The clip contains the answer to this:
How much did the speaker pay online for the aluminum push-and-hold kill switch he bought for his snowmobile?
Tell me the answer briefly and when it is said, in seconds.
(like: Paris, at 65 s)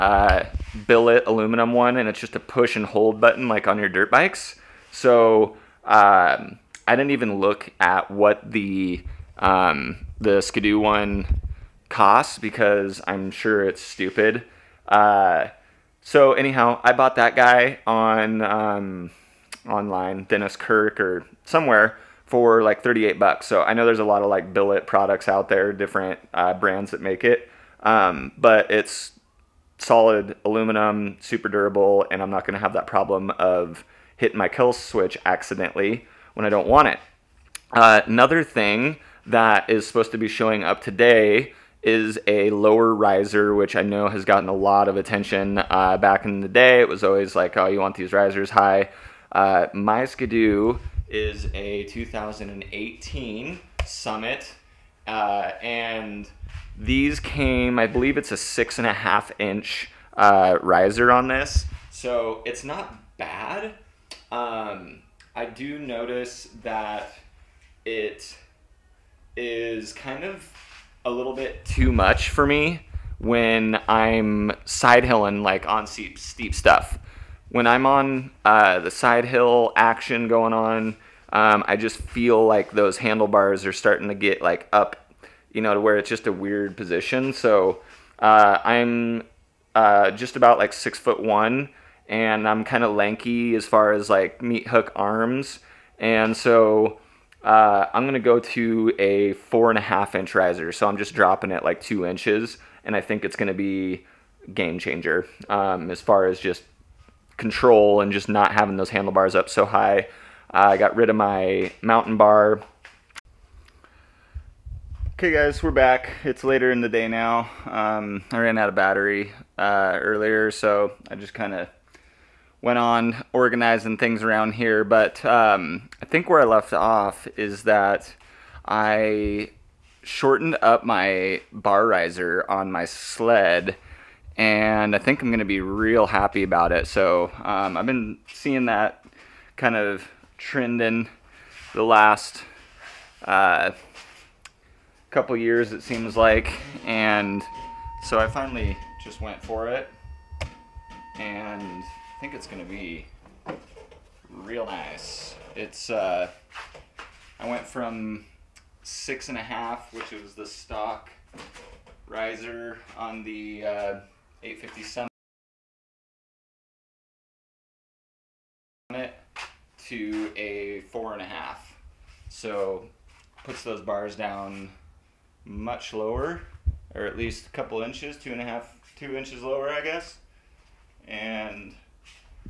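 $38, at 22 s.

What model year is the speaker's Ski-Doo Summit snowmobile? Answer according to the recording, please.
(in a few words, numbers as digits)
2018.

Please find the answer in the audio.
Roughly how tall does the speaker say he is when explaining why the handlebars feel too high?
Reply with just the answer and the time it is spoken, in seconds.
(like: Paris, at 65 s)
6'1", at 90 s.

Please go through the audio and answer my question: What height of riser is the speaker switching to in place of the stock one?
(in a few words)
4.5 inches.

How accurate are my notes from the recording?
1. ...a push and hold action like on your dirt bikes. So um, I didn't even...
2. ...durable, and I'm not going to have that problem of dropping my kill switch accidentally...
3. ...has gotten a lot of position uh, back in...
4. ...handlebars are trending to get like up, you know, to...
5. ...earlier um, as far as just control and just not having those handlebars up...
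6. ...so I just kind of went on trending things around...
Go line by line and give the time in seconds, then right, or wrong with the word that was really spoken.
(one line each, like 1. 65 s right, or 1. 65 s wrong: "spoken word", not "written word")
1. 2 s wrong: "button", not "action"
2. 31 s wrong: "hitting", not "dropping"
3. 44 s wrong: "attention", not "position"
4. 82 s wrong: "starting", not "trending"
5. 104 s wrong: "changer", not "earlier"
6. 120 s wrong: "organizing", not "trending".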